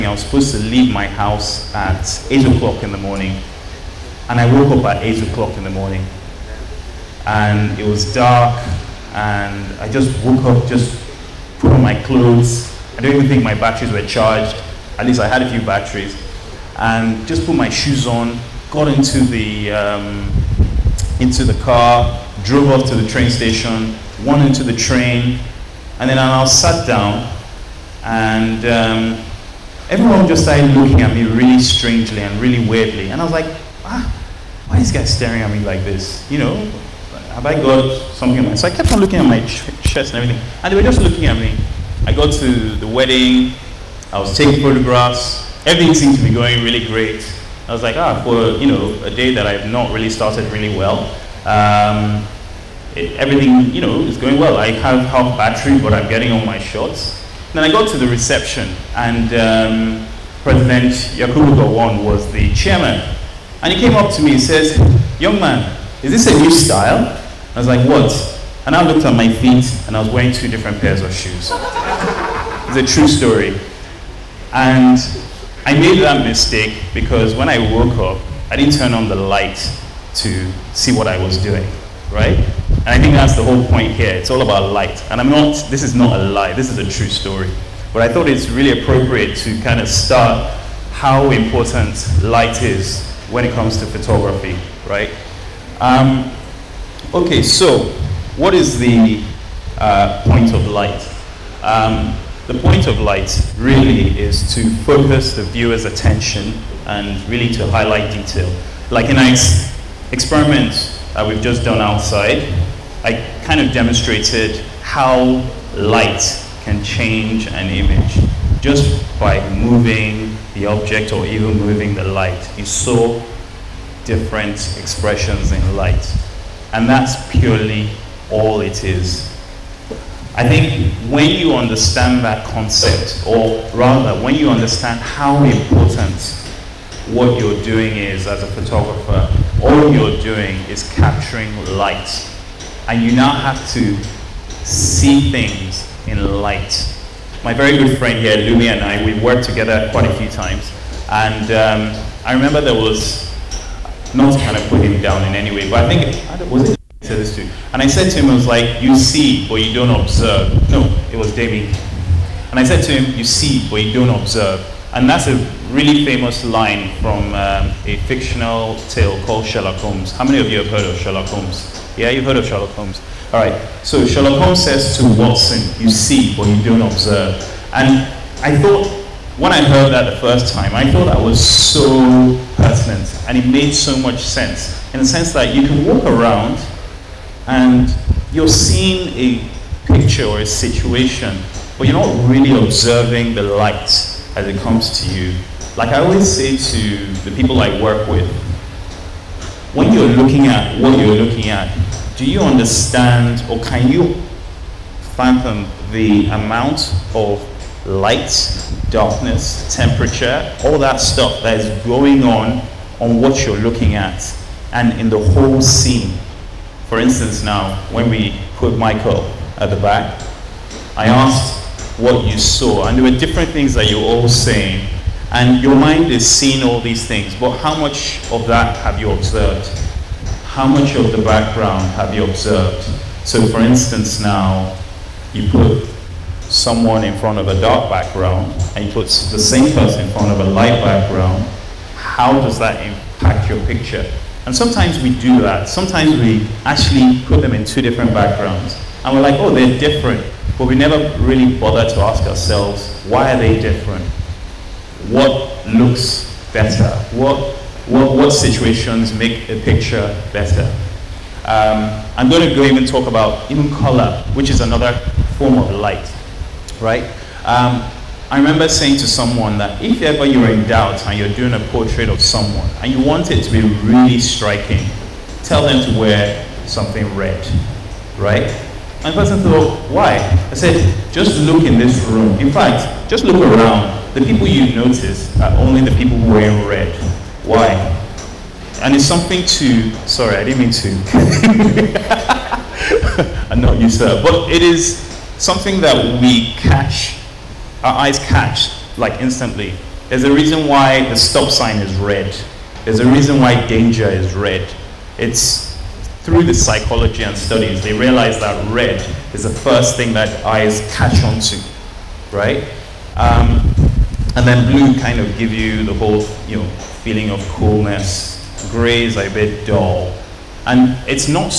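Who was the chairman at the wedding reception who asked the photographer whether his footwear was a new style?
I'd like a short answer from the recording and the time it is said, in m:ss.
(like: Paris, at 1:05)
Yakubu Gowon, at 1:01.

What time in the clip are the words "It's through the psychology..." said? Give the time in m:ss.
5:05.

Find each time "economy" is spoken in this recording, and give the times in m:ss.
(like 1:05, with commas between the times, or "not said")
not said.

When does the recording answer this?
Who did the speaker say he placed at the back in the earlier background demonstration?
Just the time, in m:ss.
3:38.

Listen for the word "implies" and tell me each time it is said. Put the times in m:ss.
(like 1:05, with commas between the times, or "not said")
not said.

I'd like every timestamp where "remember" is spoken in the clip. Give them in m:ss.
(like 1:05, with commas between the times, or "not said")
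2:32, 4:28.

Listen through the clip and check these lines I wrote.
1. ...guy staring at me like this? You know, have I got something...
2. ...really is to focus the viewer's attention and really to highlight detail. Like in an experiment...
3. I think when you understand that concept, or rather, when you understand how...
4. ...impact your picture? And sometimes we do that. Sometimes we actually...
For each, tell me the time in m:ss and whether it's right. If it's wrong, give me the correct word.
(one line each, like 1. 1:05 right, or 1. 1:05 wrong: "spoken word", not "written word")
1. 0:34 right
2. 1:43 right
3. 2:10 right
4. 4:02 right.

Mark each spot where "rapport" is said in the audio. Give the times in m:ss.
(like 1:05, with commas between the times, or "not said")
not said.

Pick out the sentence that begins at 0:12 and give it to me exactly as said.
I don't even think my batteries were charged.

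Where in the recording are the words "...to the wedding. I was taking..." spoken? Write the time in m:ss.
0:42.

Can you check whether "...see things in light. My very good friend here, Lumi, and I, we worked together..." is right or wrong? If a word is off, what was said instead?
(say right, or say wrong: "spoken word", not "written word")
right.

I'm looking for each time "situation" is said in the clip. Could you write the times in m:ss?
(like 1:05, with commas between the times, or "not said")
3:10, 4:18.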